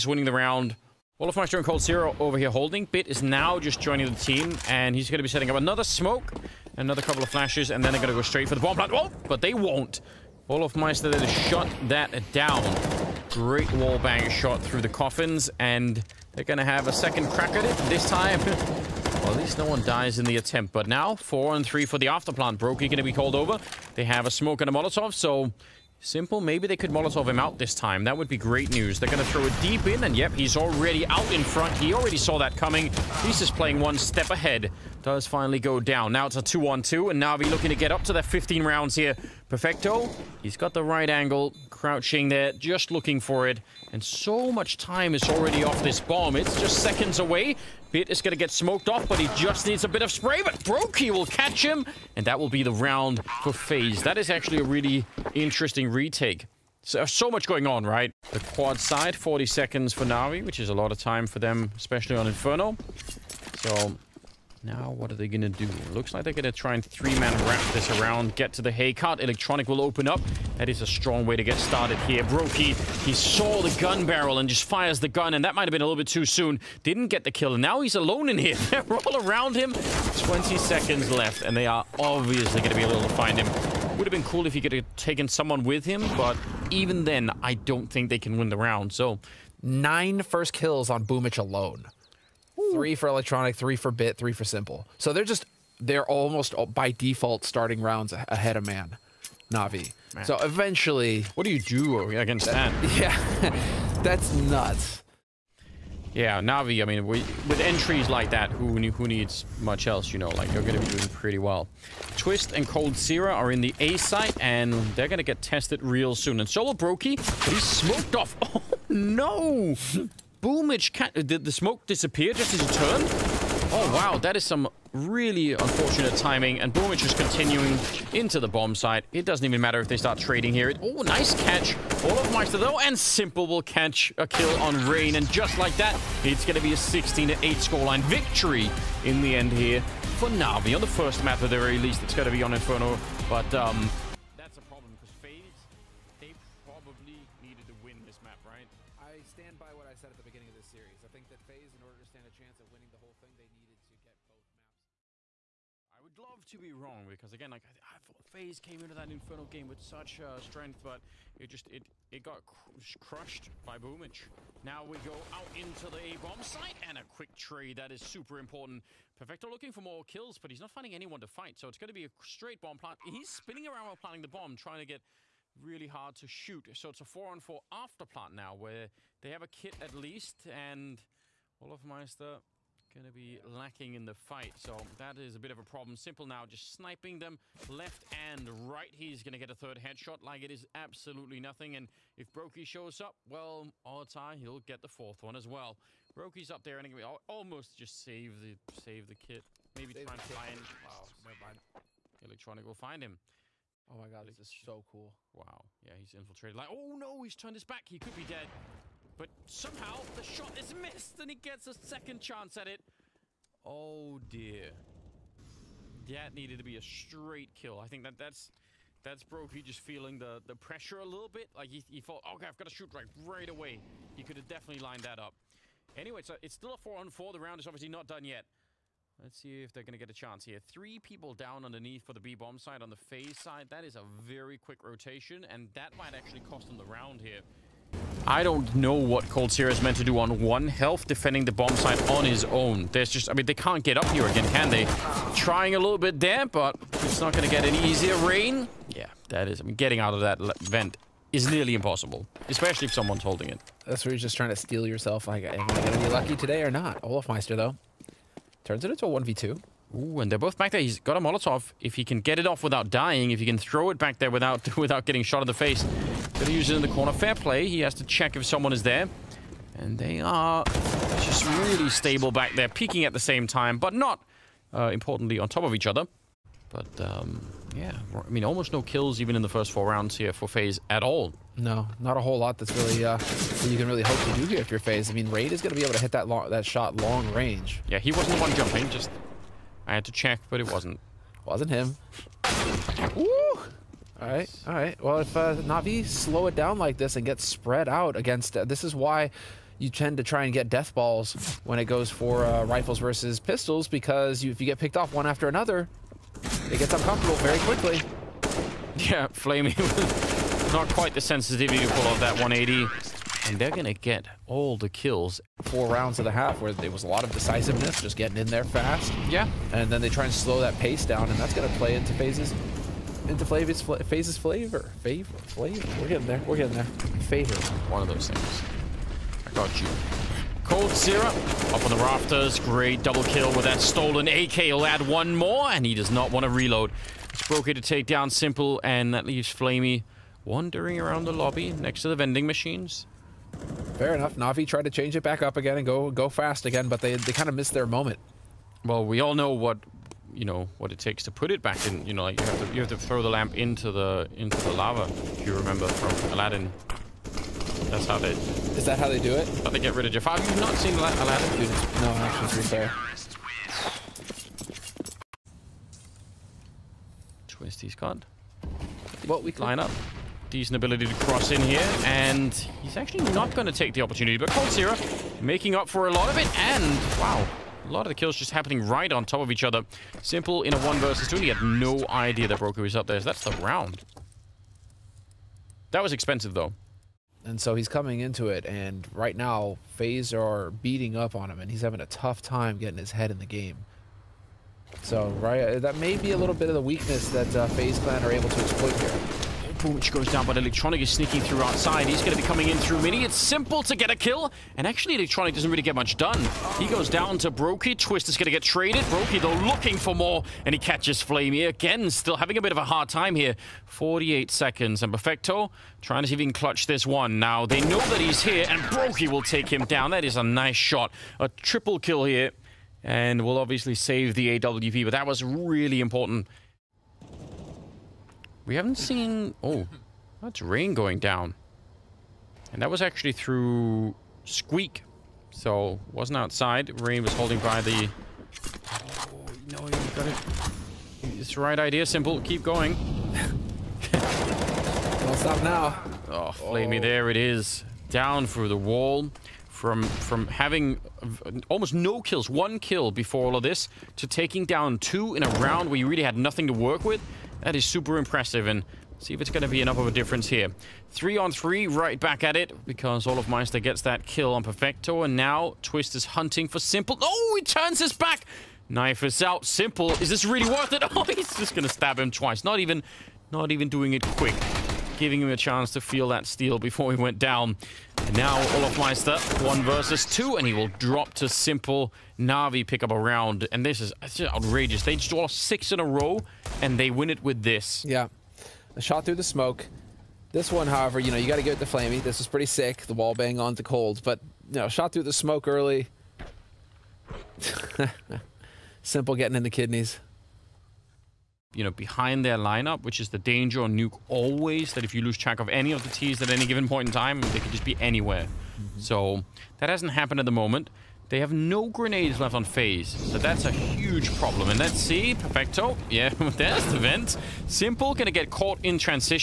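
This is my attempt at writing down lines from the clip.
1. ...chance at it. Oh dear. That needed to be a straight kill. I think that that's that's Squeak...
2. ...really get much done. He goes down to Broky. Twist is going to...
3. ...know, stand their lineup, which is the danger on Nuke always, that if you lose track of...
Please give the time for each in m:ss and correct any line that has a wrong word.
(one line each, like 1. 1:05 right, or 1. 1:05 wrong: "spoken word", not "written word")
1. 3:32 wrong: "Broky", not "Squeak"
2. 6:45 right
3. 8:21 wrong: "behind", not "stand".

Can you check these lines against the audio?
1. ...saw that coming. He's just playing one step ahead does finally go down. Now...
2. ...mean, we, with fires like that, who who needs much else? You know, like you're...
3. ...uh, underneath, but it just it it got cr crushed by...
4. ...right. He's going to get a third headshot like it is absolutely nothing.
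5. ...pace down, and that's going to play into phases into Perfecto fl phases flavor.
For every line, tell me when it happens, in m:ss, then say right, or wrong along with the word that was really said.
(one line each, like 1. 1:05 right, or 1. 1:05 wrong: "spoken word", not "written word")
1. 0:32 right
2. 1:46 wrong: "entries", not "fires"
3. 2:40 wrong: "strength", not "underneath"
4. 3:08 right
5. 5:20 wrong: "Flavius", not "Perfecto".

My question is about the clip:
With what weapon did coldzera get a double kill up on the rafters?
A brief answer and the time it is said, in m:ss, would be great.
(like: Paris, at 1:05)
Stolen AK, at 5:33.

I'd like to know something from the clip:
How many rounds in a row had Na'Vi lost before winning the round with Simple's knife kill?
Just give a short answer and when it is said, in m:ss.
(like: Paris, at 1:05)
6, at 8:05.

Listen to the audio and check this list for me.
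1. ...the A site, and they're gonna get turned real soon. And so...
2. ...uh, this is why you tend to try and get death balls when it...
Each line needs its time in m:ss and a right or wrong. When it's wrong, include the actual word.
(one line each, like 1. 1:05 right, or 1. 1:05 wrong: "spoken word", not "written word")
1. 1:53 wrong: "tested", not "turned"
2. 4:58 right.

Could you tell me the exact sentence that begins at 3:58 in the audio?
I don't know what coldzera is meant to do on one health, defending the bomb site on his own.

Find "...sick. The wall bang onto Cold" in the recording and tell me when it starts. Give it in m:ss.
8:12.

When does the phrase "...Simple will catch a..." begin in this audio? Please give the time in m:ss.
2:12.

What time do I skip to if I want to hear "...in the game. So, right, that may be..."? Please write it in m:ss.
6:33.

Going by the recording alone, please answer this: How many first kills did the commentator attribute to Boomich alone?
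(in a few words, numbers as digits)
9.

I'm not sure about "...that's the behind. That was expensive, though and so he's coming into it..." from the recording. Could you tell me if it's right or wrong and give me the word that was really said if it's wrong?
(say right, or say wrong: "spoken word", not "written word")
wrong: "round", not "behind".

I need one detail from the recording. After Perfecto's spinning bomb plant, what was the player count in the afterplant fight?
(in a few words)
4 on 4.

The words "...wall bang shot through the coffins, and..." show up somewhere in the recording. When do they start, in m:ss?
0:13.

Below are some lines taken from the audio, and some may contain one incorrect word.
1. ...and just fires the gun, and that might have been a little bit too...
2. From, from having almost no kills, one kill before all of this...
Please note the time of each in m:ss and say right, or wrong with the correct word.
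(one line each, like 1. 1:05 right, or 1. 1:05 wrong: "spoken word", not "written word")
1. 1:14 right
2. 7:29 right.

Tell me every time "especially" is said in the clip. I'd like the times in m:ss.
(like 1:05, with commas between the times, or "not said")
1:01, 4:12.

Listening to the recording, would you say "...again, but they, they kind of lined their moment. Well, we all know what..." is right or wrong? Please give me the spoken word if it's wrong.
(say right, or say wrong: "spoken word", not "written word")
wrong: "missed", not "lined".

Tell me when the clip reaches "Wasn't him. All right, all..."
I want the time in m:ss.
4:51.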